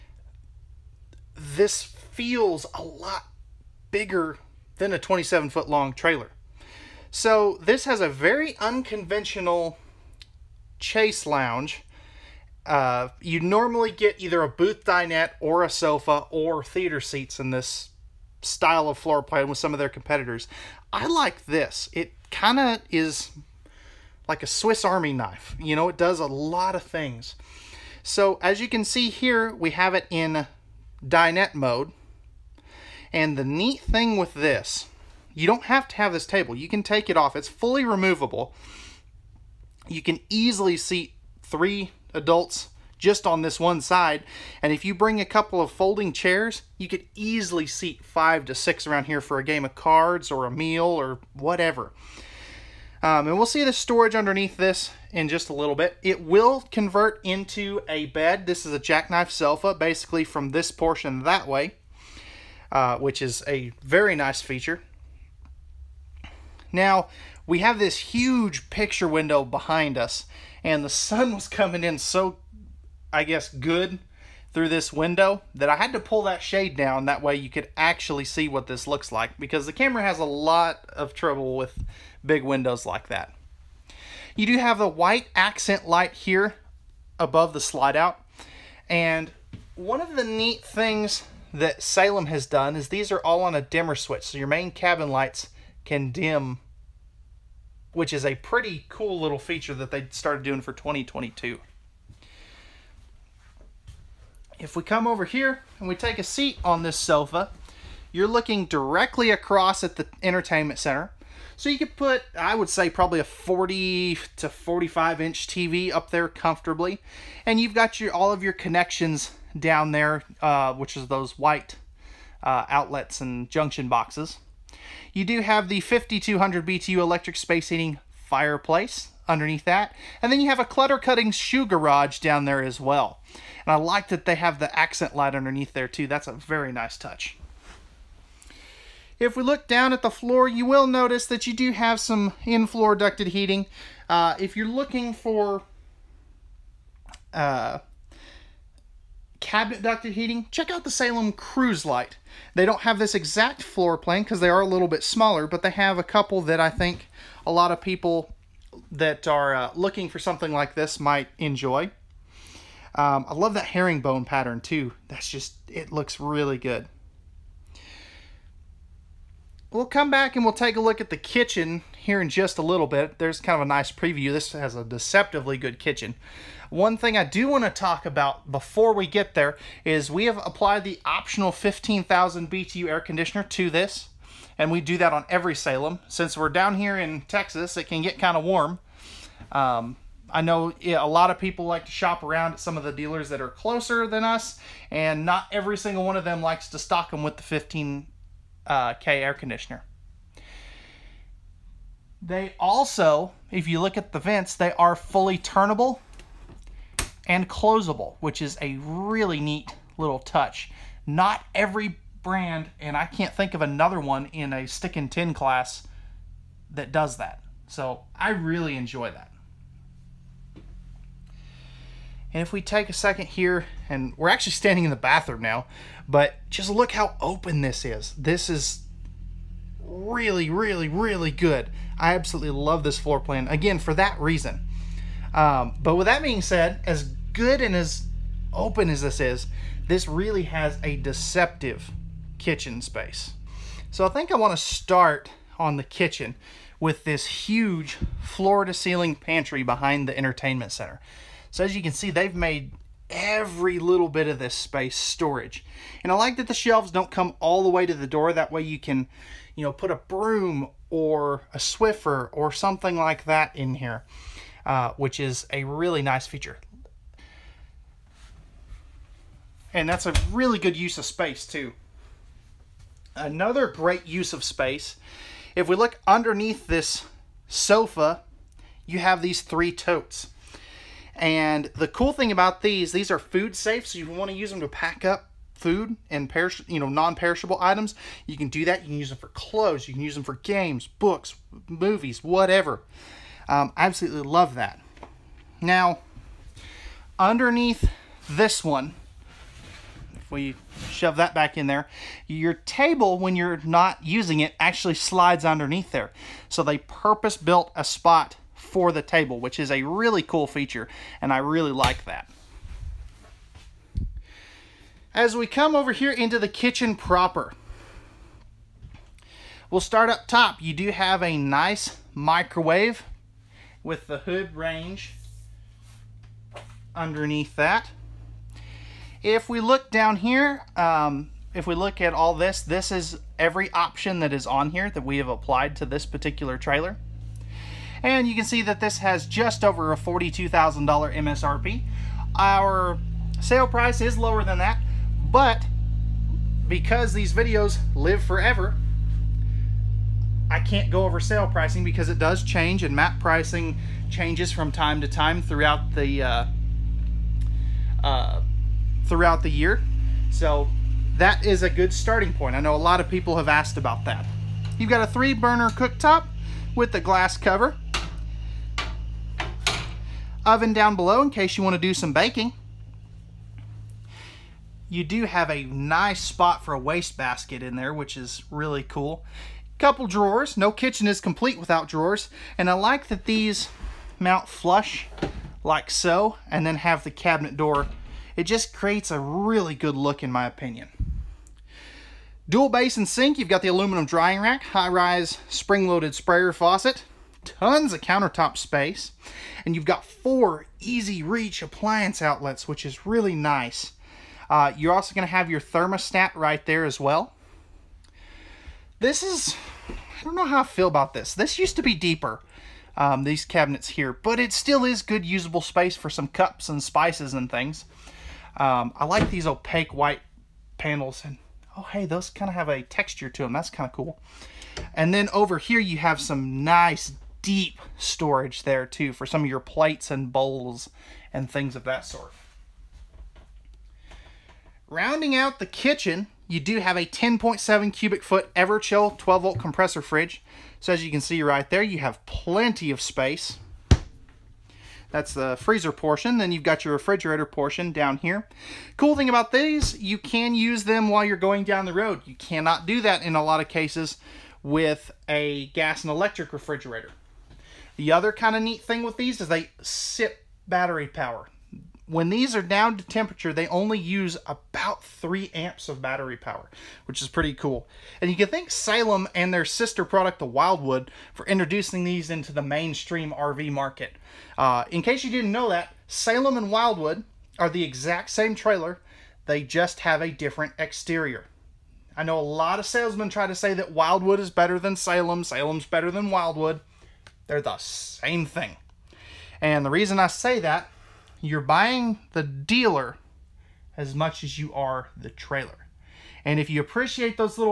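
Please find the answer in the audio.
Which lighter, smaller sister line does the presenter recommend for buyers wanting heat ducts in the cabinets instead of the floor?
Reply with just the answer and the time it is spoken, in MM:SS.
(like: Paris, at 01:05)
Salem Cruise Lite, at 02:30.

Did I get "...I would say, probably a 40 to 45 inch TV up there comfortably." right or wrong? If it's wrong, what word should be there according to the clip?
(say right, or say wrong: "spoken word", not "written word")
right.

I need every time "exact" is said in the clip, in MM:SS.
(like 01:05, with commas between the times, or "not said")
02:33, 07:57.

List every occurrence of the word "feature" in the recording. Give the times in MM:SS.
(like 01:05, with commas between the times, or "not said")
01:04, 01:39, 04:26, 05:10.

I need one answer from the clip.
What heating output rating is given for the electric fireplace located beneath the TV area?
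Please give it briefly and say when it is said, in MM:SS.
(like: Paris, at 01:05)
5200 BTU, at 02:05.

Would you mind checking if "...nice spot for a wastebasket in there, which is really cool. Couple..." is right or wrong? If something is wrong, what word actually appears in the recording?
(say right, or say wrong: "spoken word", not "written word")
right.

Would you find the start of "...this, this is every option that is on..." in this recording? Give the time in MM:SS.
05:32.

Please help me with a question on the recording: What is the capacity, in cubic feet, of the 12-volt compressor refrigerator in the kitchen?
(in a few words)
10.7 cubic feet.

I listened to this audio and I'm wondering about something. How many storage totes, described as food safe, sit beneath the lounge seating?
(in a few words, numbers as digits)
3.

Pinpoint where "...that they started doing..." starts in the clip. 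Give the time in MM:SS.
01:39.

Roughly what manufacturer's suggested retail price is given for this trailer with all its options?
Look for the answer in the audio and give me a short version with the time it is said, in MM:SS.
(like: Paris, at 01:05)
$42,000, at 05:39.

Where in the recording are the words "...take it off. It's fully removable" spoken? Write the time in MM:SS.
00:36.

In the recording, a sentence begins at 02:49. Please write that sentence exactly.
We'll come back and we'll take a look at the kitchen here in just a little bit.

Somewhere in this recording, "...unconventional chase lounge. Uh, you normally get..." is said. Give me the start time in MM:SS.
00:08.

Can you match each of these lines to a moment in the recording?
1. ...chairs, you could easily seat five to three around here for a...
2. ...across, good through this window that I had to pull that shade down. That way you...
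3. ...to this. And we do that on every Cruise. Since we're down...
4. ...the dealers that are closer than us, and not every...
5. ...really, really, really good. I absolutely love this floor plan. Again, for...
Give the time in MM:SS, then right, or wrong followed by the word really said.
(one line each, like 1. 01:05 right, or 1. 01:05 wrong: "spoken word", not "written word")
1. 00:46 wrong: "six", not "three"
2. 01:13 wrong: "guess", not "across"
3. 03:03 wrong: "Salem", not "Cruise"
4. 03:12 right
5. 03:49 right.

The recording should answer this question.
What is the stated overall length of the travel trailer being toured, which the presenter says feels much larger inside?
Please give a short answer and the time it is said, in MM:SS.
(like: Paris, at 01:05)
27 feet, at 00:04.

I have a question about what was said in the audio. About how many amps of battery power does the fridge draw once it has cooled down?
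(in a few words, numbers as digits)
3 amps.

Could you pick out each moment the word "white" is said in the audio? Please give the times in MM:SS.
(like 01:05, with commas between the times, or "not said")
01:24, 02:01, 06:59.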